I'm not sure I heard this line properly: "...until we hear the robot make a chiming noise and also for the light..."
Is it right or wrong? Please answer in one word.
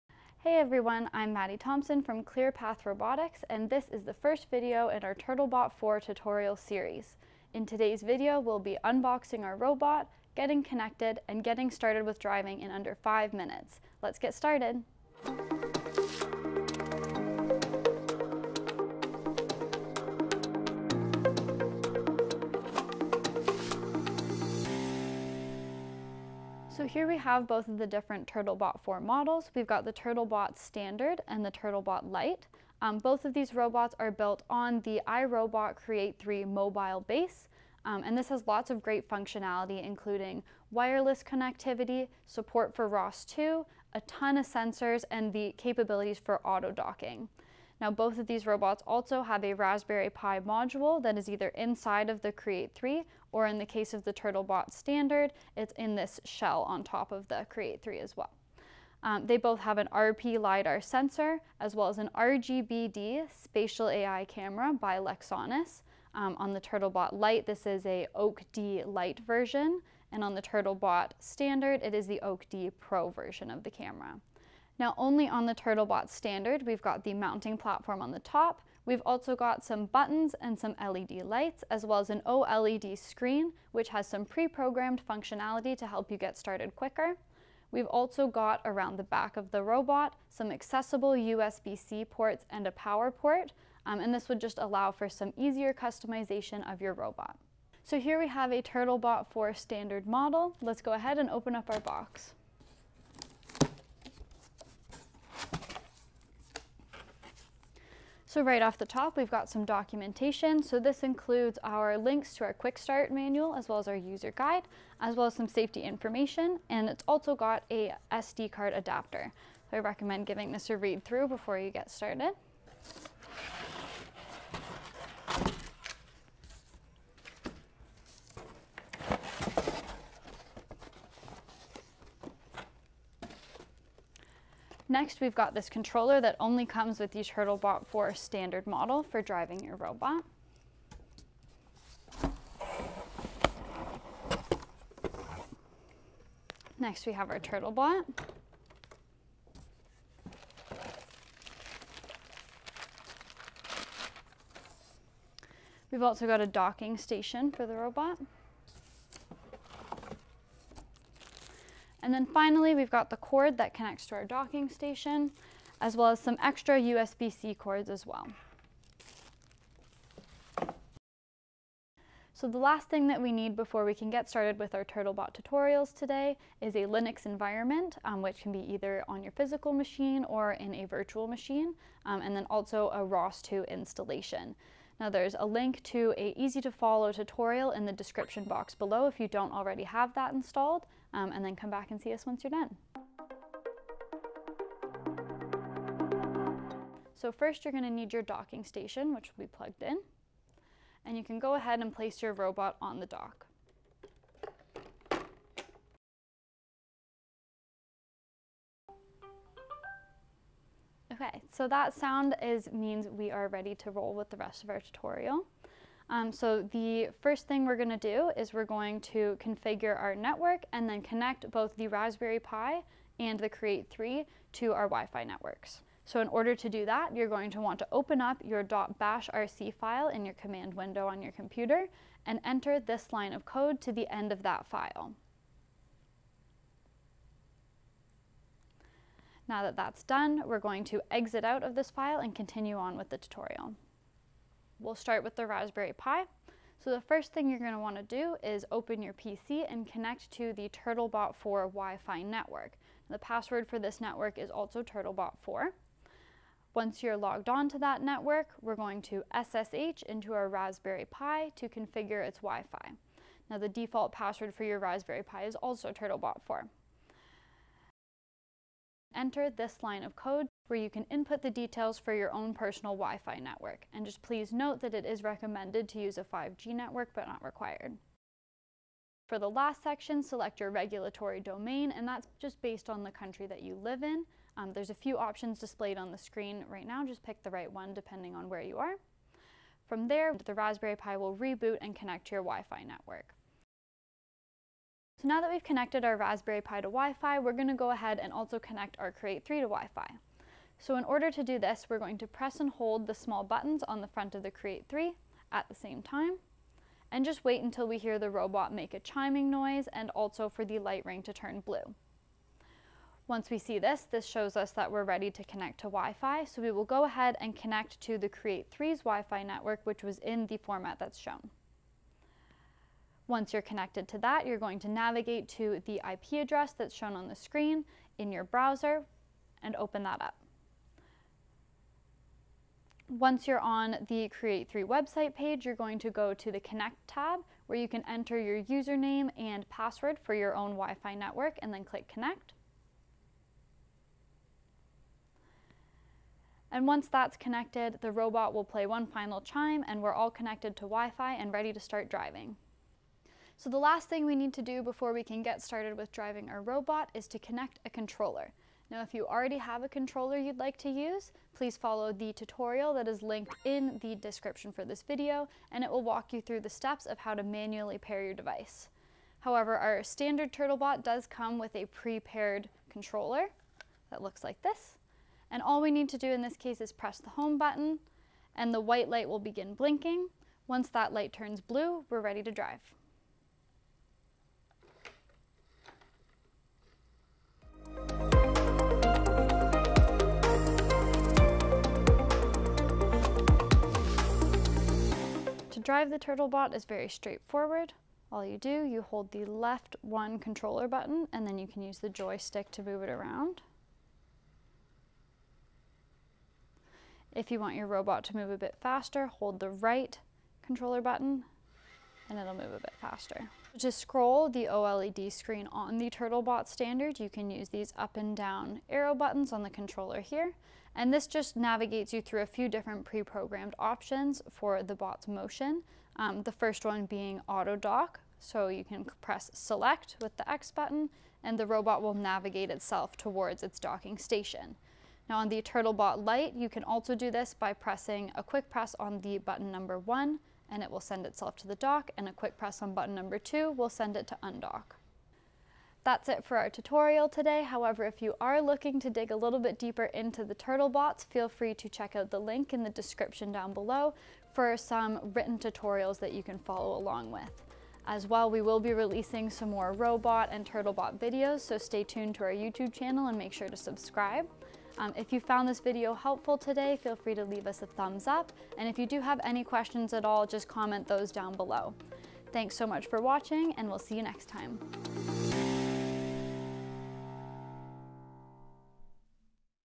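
right.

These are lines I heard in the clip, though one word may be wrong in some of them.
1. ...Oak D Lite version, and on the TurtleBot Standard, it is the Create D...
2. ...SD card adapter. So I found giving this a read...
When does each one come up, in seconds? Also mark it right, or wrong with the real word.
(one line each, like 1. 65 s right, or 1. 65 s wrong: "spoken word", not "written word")
1. 68 s wrong: "Oak", not "Create"
2. 118 s wrong: "recommend", not "found".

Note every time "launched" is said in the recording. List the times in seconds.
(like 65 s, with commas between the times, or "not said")
not said.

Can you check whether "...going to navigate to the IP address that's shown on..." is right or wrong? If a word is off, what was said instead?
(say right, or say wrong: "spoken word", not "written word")
right.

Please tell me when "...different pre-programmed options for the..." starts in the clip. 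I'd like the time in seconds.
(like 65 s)
422 s.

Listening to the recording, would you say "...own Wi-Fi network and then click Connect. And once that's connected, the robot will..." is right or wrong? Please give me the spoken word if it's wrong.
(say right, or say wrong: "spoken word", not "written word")
right.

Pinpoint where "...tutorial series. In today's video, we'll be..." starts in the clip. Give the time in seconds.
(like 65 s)
5 s.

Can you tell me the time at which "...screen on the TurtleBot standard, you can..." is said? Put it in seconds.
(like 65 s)
415 s.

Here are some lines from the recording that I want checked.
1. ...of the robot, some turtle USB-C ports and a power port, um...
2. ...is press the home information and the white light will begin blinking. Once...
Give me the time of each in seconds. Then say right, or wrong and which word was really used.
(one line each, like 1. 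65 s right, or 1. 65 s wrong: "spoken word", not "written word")
1. 89 s wrong: "accessible", not "turtle"
2. 376 s wrong: "button", not "information".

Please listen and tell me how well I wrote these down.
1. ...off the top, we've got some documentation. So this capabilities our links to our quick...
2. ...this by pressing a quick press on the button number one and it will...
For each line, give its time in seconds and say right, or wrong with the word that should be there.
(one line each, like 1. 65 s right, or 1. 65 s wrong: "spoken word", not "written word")
1. 108 s wrong: "includes", not "capabilities"
2. 437 s right.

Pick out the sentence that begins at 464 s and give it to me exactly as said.
Um, if you found this video helpful today, feel free to leave us a thumbs up.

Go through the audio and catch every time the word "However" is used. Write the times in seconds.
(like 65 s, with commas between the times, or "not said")
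369 s, 447 s.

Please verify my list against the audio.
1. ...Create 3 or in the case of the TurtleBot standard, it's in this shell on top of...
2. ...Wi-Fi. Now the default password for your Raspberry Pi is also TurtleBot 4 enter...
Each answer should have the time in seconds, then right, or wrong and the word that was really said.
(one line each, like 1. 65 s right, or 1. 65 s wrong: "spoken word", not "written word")
1. 52 s right
2. 262 s right.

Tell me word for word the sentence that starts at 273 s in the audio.
And just please note that it is recommended to use a 5G network, but not required.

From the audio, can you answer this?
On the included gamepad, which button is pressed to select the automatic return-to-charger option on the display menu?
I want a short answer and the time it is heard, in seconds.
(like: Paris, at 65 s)
X button, at 430 s.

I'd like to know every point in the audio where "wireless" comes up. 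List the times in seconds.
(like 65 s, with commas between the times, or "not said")
40 s.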